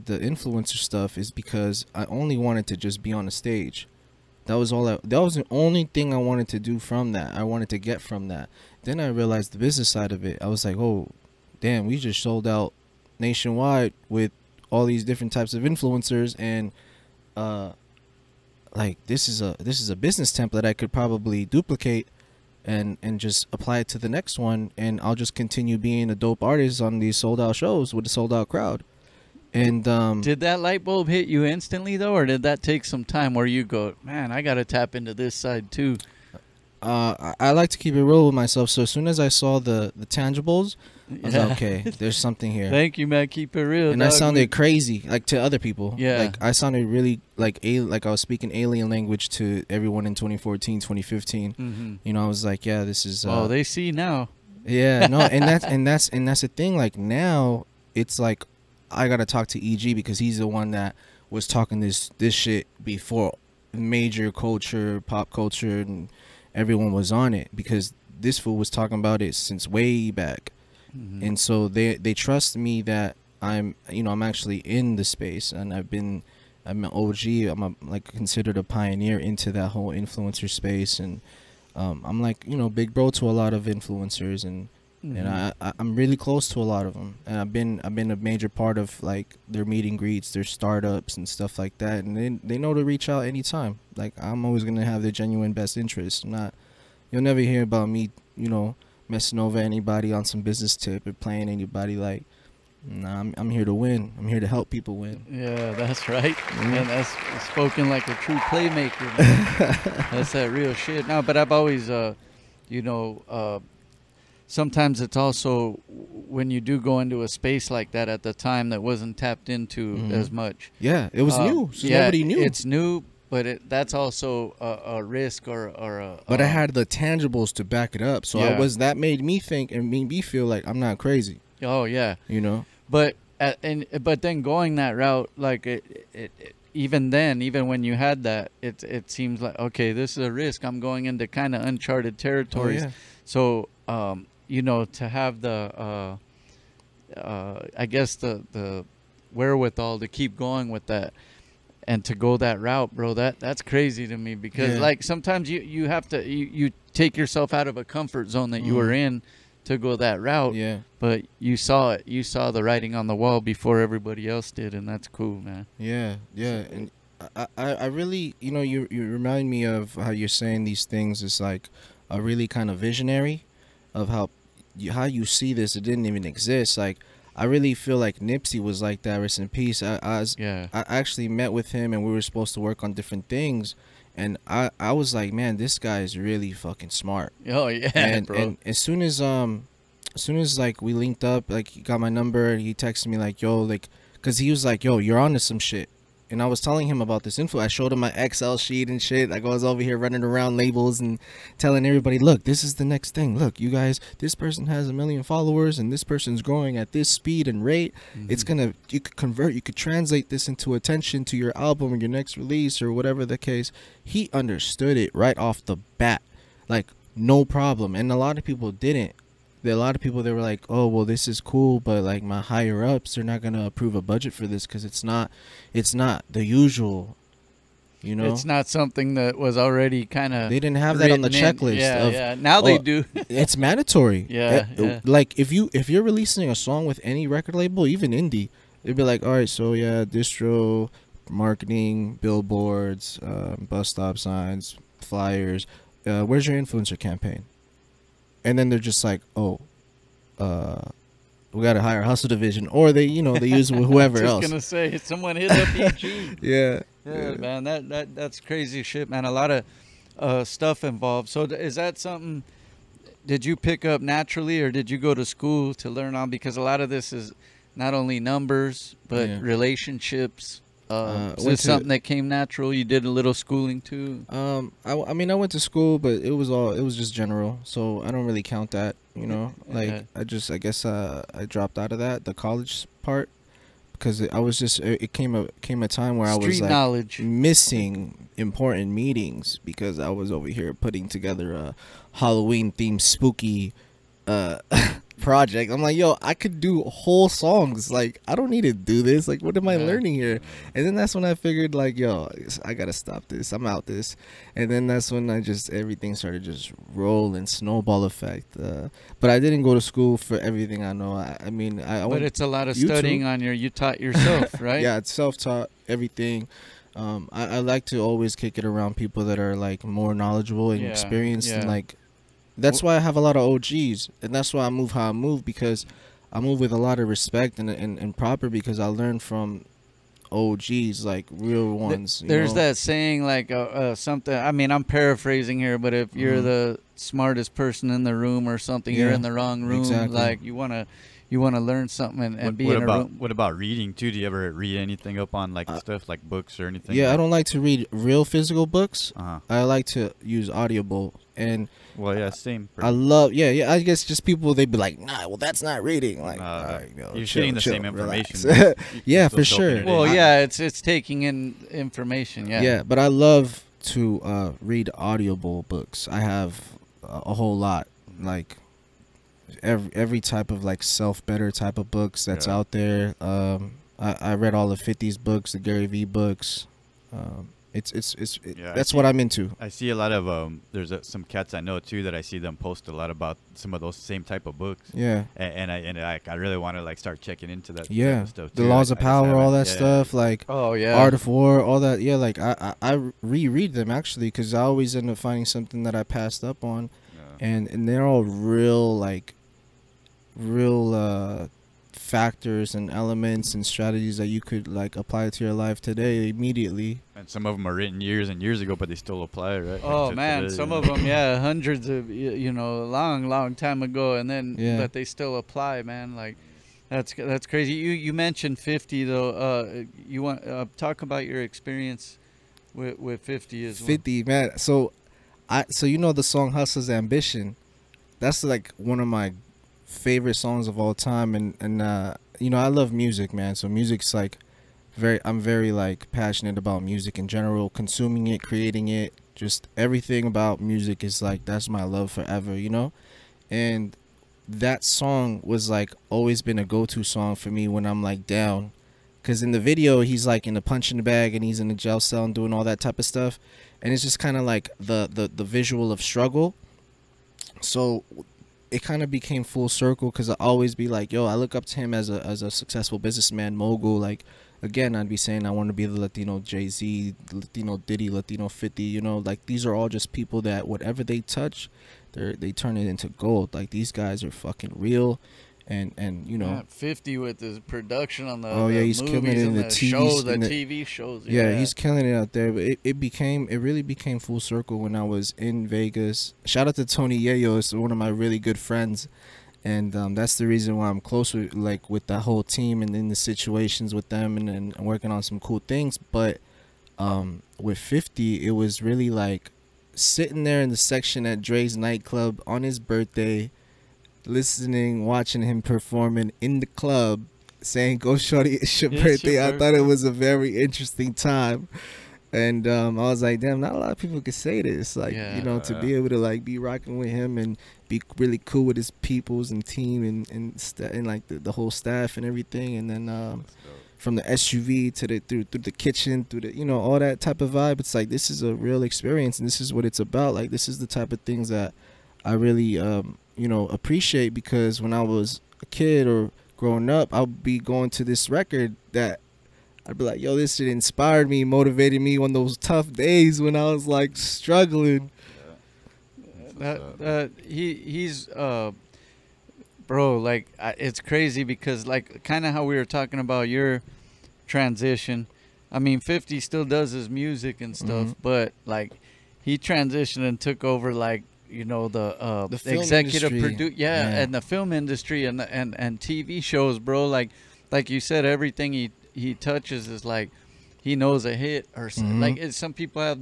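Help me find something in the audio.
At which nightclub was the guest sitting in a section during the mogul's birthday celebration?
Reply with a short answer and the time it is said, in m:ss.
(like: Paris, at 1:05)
Drai's, at 8:21.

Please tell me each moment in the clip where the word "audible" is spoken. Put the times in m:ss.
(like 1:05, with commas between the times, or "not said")
5:50, 6:04.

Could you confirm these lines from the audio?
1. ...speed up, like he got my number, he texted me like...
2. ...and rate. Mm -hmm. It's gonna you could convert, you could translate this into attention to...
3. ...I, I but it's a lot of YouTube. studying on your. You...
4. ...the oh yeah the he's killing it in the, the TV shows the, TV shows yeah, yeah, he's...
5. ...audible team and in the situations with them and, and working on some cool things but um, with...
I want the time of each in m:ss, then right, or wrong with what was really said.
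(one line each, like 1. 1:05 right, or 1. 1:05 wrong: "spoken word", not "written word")
1. 3:10 wrong: "linked", not "speed"
2. 3:27 right
3. 5:11 right
4. 7:58 right
5. 8:12 wrong: "whole", not "audible".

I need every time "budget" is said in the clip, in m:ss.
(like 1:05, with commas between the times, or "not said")
3:44.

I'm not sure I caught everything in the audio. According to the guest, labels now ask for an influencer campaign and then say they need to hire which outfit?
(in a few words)
Hustle Division.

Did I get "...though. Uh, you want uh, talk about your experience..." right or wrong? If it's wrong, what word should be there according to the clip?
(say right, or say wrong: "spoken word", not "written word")
right.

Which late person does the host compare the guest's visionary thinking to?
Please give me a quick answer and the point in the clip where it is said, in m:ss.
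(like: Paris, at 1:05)
Nipsey, at 2:58.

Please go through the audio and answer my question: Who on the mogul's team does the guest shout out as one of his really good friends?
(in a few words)
Tony Yayo.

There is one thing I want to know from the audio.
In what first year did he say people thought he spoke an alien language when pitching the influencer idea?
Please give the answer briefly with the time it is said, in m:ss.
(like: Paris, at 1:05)
2014, at 0:50.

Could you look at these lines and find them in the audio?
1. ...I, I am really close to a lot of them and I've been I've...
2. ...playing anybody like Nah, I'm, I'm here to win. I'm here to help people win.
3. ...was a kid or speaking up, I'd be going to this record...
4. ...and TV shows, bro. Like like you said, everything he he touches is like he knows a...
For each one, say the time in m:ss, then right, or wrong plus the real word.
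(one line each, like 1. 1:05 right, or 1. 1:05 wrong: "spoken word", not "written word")
1. 1:25 right
2. 1:41 right
3. 8:55 wrong: "growing", not "speaking"
4. 9:25 right.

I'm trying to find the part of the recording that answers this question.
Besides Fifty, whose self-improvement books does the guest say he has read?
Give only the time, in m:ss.
6:15.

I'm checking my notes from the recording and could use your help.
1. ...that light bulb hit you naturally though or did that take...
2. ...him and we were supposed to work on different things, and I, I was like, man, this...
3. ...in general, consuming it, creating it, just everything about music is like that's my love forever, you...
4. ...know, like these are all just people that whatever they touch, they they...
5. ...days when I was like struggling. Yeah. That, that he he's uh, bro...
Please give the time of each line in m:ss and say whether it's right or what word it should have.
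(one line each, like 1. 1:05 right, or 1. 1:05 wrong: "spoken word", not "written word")
1. 0:30 wrong: "instantly", not "naturally"
2. 3:01 right
3. 7:17 right
4. 7:48 right
5. 9:02 right.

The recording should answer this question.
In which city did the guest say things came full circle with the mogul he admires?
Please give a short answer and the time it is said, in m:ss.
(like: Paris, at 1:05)
Vegas, at 8:05.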